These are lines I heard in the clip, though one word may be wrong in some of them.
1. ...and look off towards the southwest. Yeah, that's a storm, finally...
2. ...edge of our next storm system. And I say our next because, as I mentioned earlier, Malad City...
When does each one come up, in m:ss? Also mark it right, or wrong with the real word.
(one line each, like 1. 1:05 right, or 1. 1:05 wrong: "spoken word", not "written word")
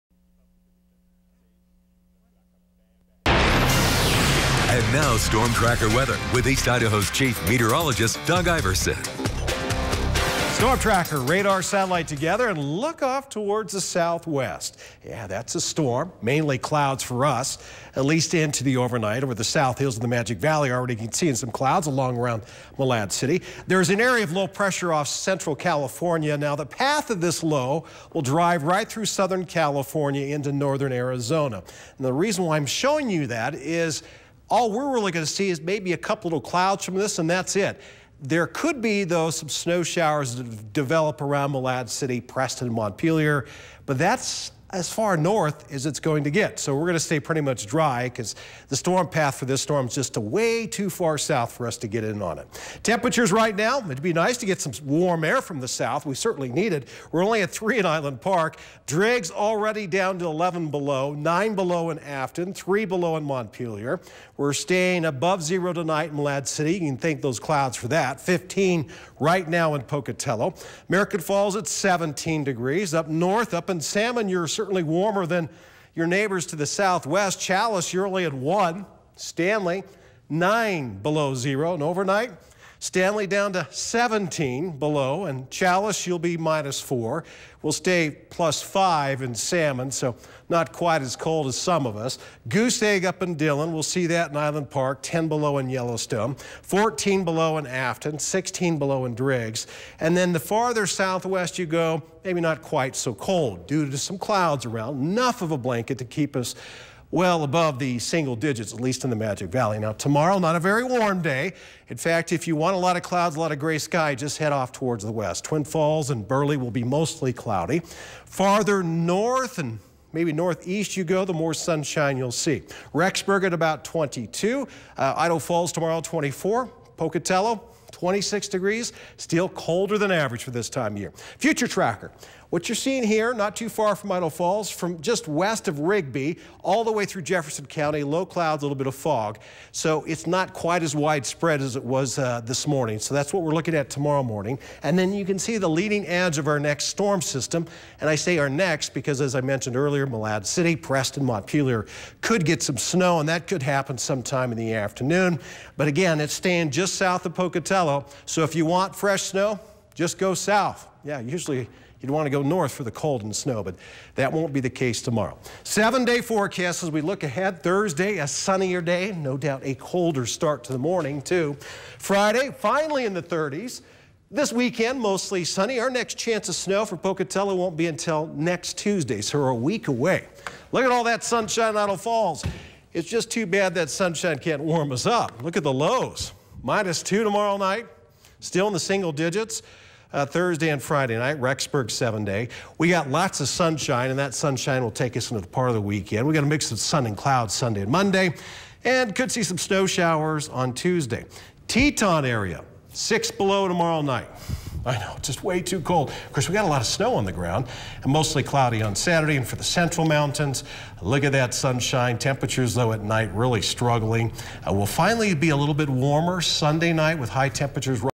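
1. 0:12 wrong: "mainly", not "finally"
2. 2:26 right.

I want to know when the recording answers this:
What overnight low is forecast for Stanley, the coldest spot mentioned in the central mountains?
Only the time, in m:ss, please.
1:23.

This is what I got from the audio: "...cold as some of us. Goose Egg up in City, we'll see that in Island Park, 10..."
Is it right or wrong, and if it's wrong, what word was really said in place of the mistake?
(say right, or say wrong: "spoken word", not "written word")
wrong: "Dillon", not "City".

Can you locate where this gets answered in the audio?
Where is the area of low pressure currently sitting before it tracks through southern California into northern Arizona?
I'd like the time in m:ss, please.
0:24.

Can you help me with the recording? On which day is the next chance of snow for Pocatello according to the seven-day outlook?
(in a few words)
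Next Tuesday.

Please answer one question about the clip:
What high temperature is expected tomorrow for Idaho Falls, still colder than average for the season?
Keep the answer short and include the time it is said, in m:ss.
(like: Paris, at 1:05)
24, at 2:05.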